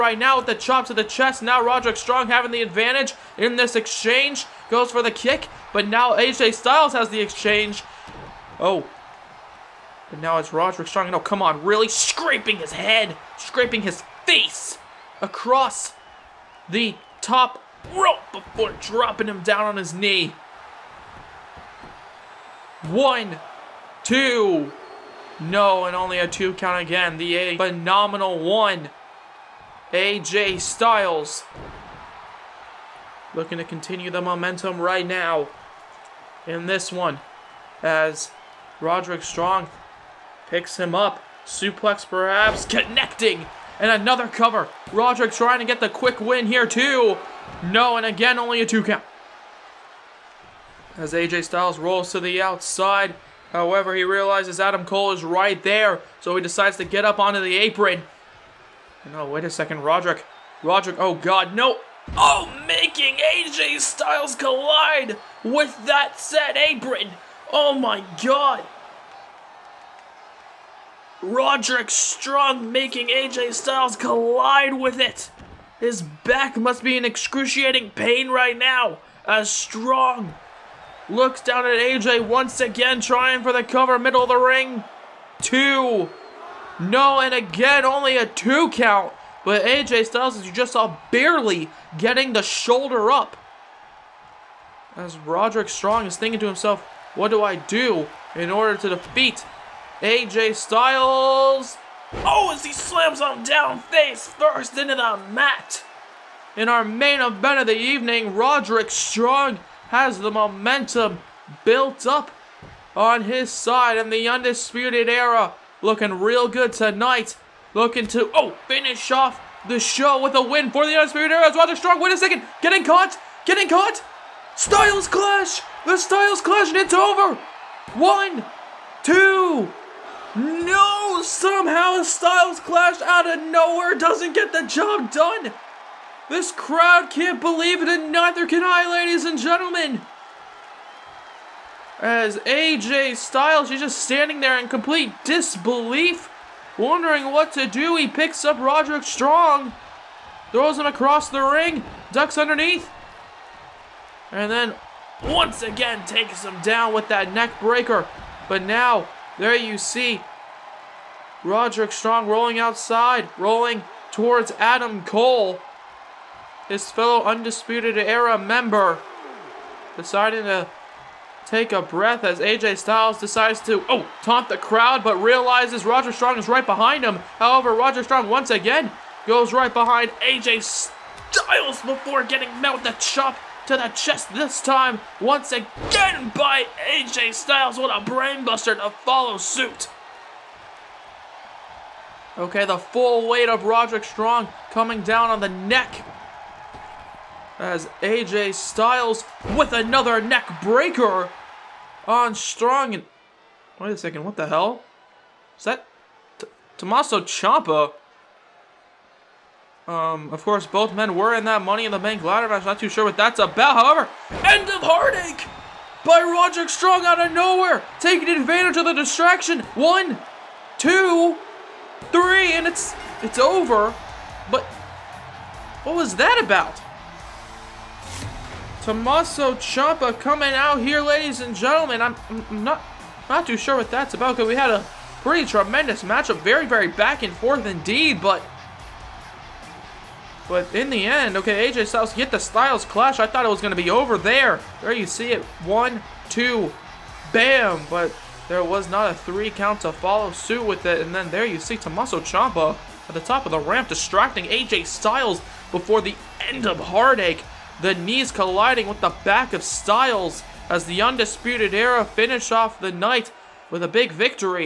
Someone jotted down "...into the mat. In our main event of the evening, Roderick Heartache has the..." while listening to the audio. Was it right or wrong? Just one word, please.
wrong.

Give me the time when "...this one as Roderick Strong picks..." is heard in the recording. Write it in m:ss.
0:36.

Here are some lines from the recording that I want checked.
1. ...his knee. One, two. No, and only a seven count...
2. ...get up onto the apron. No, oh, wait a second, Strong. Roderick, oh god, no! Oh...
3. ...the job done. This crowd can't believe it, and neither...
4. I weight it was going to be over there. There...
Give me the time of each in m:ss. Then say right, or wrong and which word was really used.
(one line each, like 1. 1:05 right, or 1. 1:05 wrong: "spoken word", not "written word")
1. 0:19 wrong: "two", not "seven"
2. 0:56 wrong: "Roderick", not "Strong"
3. 2:14 right
4. 4:03 wrong: "thought", not "weight".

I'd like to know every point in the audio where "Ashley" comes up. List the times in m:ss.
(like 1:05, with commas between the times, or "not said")
not said.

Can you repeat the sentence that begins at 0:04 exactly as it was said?
Goes for the kick, but now AJ Styles has the exchange.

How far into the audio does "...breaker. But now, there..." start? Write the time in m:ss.
2:37.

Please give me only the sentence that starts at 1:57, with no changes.
Looking to, oh, finish off the show with a win for the Undisputed Era.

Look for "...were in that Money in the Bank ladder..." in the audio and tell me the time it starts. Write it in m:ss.
3:31.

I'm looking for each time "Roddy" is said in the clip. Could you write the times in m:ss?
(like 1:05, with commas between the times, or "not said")
2:01.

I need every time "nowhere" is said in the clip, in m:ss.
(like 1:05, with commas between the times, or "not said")
2:13, 3:37.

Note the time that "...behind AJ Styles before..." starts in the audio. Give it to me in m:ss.
2:59.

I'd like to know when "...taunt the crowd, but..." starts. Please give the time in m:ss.
2:54.